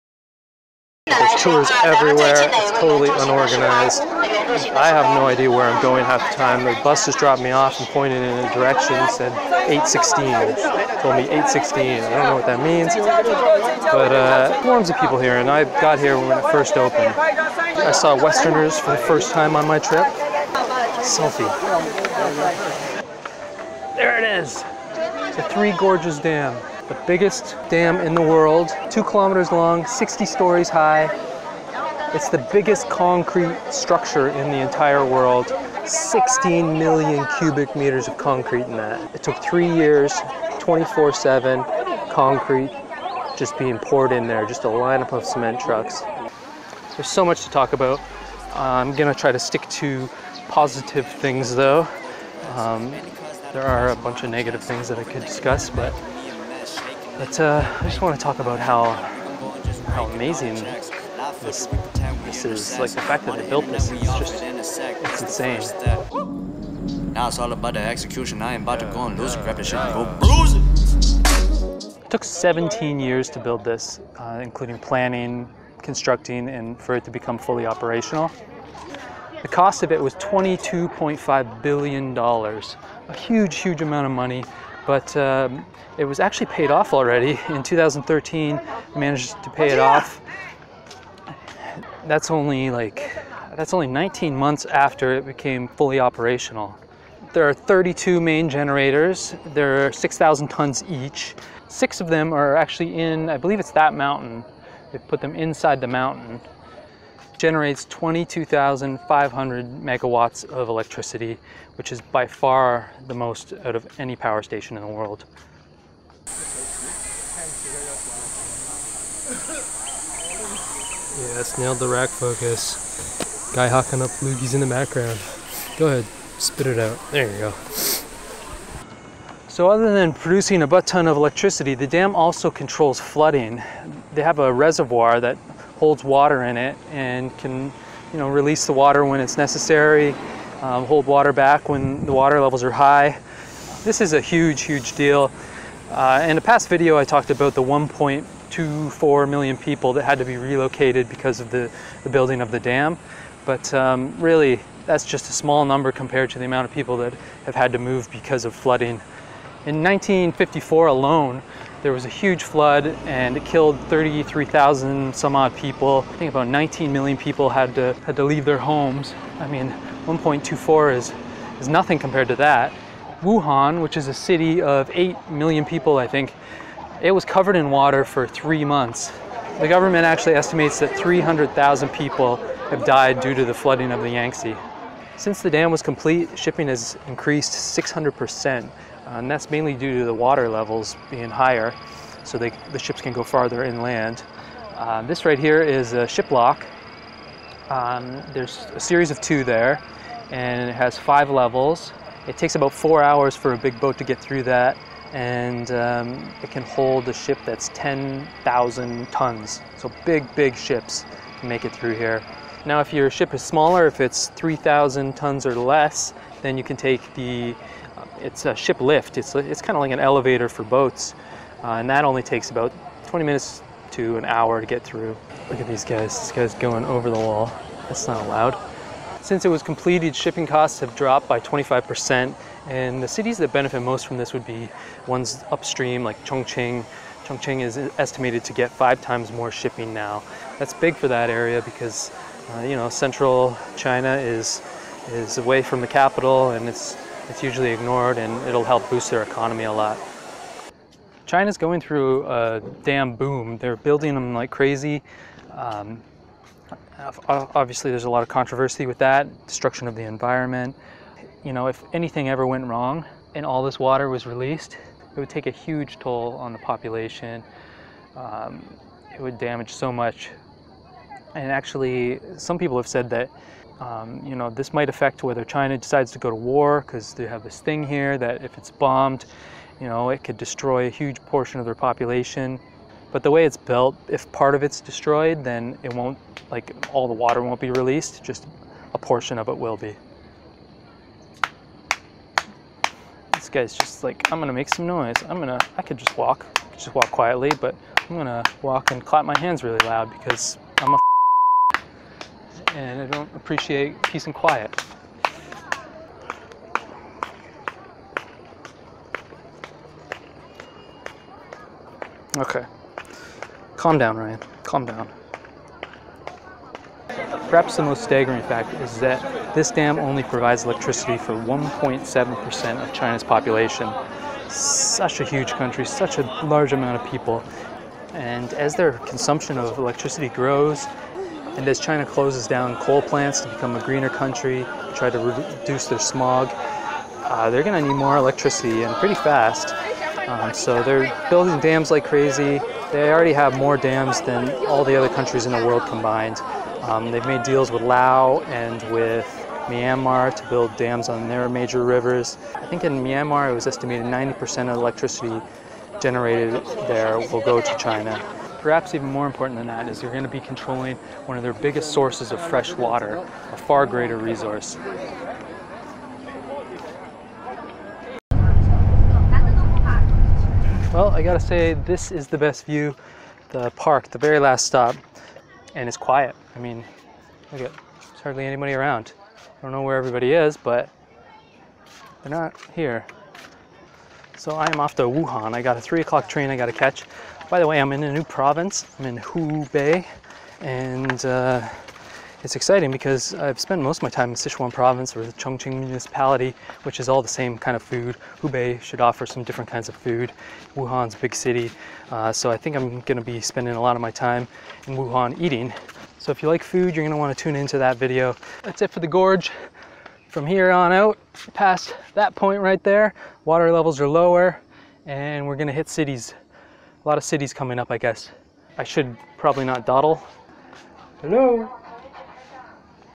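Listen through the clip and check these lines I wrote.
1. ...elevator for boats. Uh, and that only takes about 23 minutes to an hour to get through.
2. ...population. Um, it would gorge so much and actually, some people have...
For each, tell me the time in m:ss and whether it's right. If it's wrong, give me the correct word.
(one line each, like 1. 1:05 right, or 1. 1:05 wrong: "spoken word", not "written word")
1. 3:39 wrong: "20", not "23"
2. 4:26 wrong: "damage", not "gorge".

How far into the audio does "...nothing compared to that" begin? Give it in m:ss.
2:51.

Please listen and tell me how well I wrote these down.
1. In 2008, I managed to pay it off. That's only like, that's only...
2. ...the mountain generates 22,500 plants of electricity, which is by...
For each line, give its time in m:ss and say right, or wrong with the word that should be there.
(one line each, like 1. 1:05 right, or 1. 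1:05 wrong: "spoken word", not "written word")
1. 1:27 wrong: "2013", not "2008"
2. 1:45 wrong: "megawatts", not "plants".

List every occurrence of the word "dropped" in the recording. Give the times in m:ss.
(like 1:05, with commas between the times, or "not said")
0:07, 3:50.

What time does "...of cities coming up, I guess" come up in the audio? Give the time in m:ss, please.
6:57.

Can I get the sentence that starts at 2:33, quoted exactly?
But um, really, that's just a small number compared to the amount of people that have had to move because of flooding.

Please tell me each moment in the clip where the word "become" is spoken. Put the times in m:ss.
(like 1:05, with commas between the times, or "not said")
1:17, 5:33.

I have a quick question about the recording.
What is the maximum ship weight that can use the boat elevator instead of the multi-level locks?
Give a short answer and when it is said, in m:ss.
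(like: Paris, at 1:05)
3,000 tons, at 3:34.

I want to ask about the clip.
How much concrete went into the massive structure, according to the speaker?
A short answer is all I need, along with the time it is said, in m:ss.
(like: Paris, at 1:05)
16 million cubic meters, at 0:35.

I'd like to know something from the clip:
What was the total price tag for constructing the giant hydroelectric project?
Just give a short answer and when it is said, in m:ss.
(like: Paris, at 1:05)
$22.5 billion, at 1:20.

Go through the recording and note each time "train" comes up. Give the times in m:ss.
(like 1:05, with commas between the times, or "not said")
6:26.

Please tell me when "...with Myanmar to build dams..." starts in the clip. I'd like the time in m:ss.
5:48.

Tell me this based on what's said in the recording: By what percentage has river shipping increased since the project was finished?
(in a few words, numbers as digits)
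600%.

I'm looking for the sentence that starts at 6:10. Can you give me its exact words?
Well, I gotta say, this is the best view, the park, the very last stop, and it's quiet.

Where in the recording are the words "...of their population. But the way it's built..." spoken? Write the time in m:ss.
4:41.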